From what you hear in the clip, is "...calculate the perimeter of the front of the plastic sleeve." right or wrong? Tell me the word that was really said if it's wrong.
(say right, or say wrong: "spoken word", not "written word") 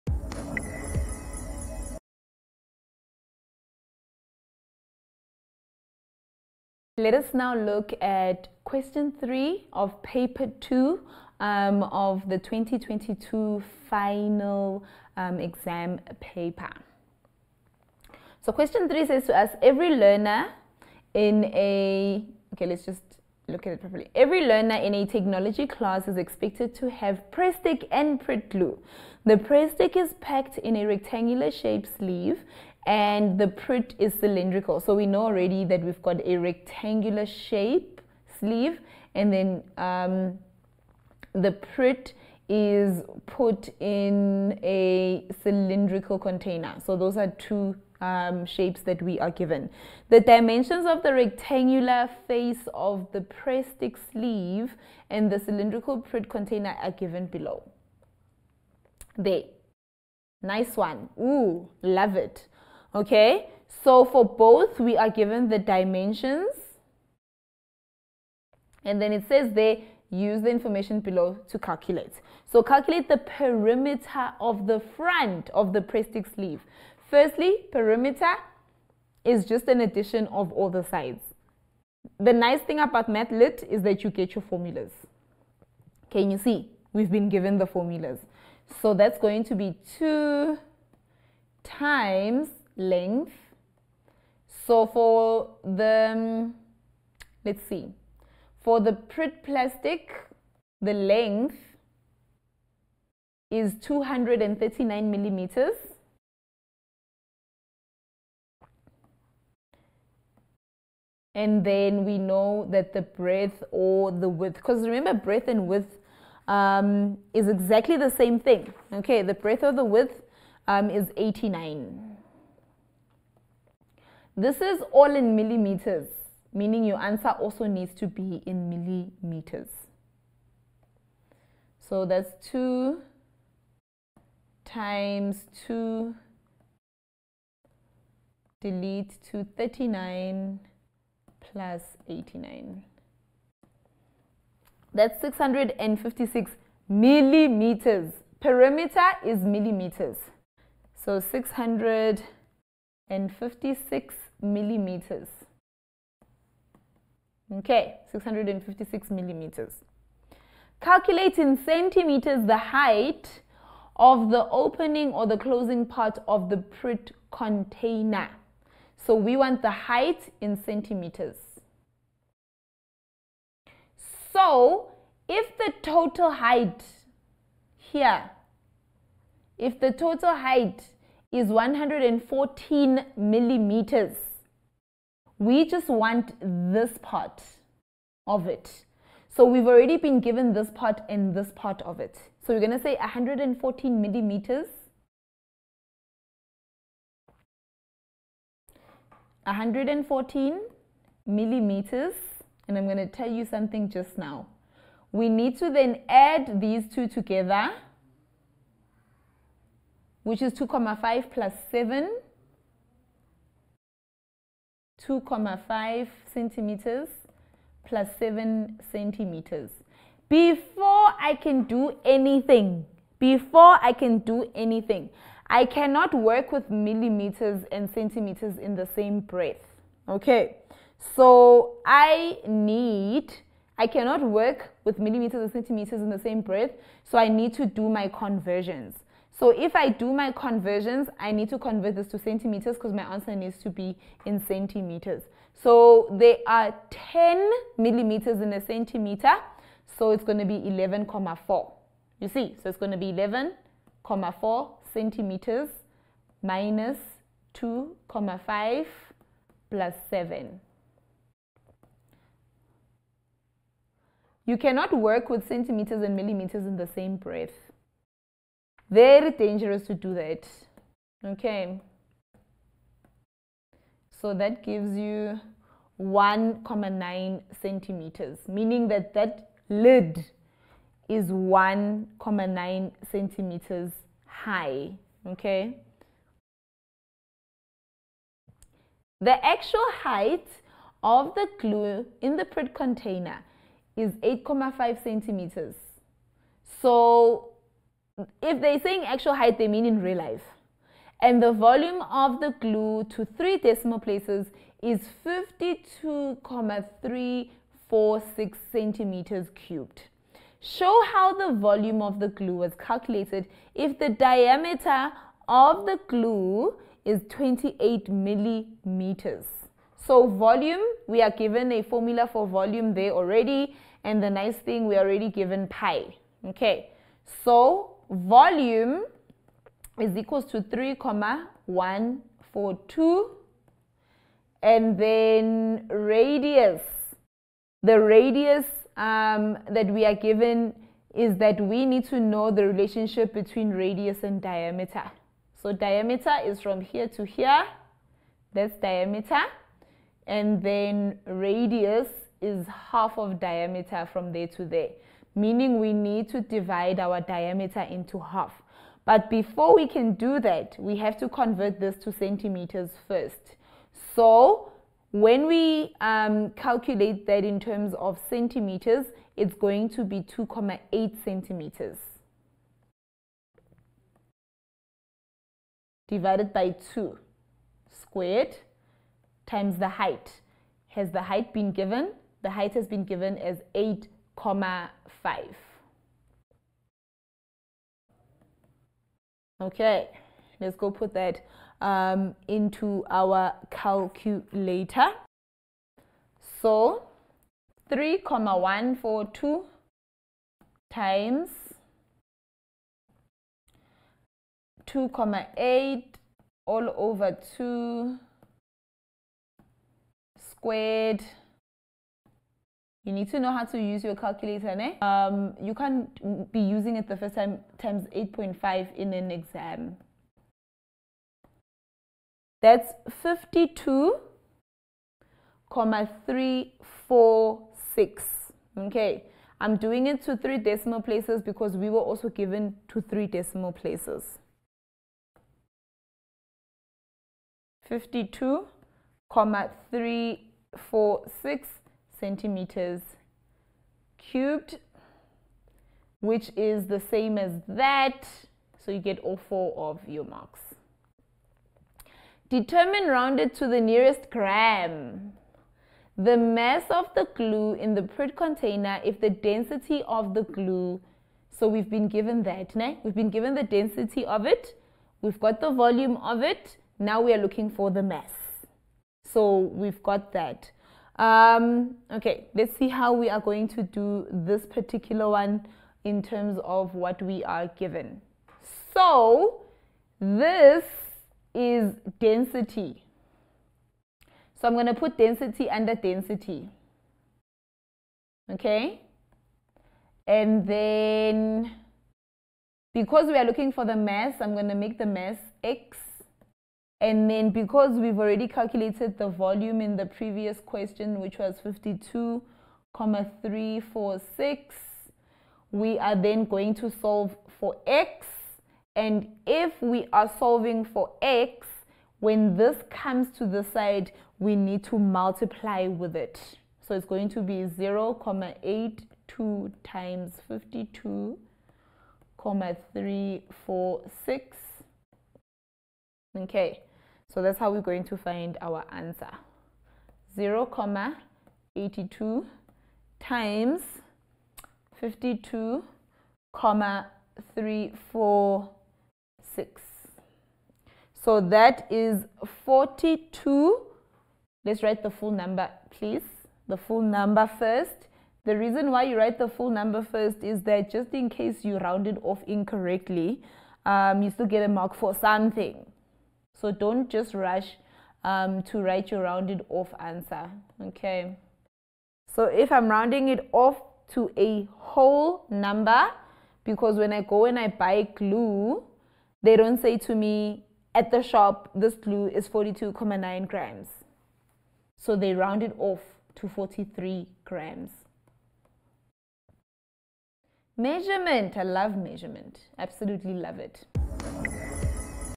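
right.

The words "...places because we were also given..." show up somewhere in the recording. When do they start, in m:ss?
7:11.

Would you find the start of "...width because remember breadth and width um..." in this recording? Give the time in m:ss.
1:54.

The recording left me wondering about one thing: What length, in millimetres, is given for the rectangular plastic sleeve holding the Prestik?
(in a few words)
239 millimeters.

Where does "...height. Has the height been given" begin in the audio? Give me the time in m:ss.
6:19.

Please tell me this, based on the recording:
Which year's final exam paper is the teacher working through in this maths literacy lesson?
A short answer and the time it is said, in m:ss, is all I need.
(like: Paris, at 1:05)
2022, at 0:12.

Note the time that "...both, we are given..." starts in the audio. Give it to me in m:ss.
1:04.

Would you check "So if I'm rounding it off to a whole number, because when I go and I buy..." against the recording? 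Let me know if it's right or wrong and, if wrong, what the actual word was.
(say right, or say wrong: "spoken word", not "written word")
right.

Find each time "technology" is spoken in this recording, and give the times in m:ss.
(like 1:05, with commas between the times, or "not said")
0:25.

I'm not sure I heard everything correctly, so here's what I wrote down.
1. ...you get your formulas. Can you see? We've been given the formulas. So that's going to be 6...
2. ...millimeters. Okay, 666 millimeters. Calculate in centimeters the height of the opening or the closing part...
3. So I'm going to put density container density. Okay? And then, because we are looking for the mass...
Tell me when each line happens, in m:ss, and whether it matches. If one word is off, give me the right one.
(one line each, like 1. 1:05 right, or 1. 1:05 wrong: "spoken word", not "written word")
1. 1:24 wrong: "2", not "6"
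2. 2:34 wrong: "656", not "666"
3. 8:04 wrong: "under", not "container".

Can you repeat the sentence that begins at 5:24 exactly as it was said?
And the nice thing, we are already given pi.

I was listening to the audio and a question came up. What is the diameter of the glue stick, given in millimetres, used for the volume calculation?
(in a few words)
28 millimeters.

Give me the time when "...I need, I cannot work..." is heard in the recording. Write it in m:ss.
3:51.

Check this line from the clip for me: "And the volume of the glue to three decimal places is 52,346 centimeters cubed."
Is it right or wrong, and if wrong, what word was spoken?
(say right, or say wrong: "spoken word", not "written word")
right.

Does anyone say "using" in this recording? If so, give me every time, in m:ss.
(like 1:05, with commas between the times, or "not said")
6:56.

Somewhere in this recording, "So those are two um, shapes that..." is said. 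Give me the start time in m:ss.
0:46.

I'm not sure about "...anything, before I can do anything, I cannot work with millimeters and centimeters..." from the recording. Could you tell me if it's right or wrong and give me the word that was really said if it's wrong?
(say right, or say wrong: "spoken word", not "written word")
right.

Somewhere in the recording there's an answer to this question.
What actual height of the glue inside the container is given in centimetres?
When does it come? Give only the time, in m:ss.
4:54.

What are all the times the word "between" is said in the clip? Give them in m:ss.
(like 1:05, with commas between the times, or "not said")
5:43.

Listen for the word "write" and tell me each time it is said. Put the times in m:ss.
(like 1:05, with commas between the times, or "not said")
9:04, 9:09, 9:18.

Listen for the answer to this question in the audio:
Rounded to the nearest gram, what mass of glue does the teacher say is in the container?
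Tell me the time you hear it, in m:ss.
9:36.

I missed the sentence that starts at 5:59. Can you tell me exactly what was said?
But before we can do that, we have to convert this to centimeters first.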